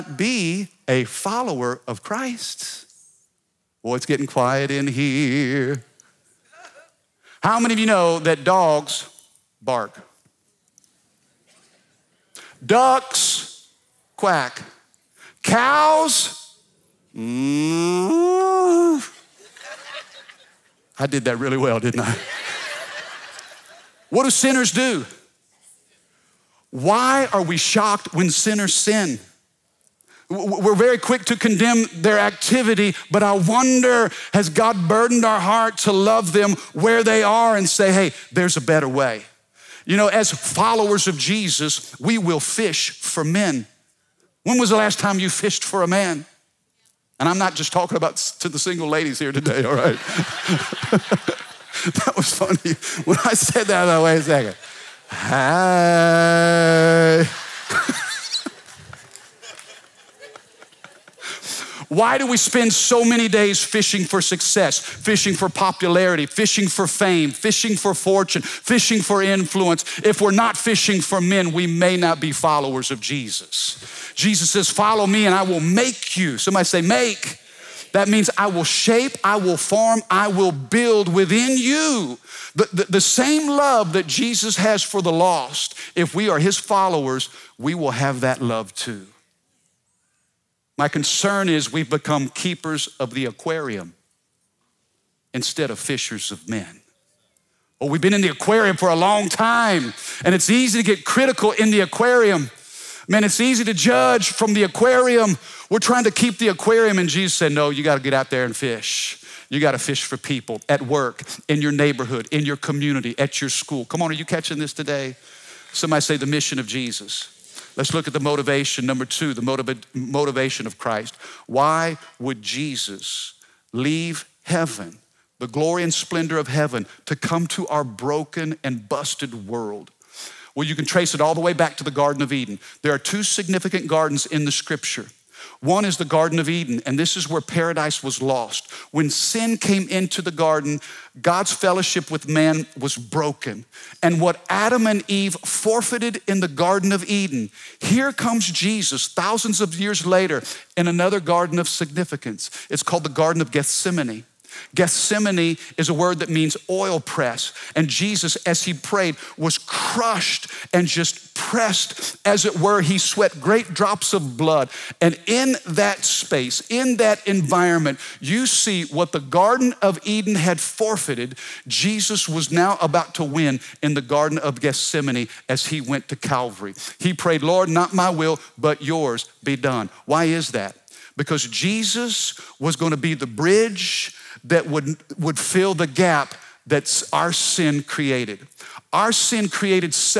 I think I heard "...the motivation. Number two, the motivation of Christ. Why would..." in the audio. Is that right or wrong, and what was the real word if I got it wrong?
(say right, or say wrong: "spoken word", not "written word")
right.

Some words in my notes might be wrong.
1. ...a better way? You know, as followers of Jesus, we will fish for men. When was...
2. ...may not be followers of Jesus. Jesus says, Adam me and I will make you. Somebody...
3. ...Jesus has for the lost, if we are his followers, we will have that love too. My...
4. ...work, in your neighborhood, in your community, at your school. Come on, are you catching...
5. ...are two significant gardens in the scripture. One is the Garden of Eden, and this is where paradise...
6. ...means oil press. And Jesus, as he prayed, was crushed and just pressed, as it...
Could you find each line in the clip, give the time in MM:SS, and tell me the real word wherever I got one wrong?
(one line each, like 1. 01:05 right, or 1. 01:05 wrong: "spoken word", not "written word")
1. 00:38 right
2. 01:11 wrong: "Follow", not "Adam"
3. 01:24 right
4. 01:50 right
5. 02:12 right
6. 02:36 right.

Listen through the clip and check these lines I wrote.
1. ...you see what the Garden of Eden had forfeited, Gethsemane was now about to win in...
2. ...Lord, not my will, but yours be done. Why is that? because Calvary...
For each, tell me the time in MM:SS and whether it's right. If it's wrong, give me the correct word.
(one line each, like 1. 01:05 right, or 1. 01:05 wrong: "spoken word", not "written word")
1. 02:48 wrong: "Jesus", not "Gethsemane"
2. 02:57 wrong: "Jesus", not "Calvary".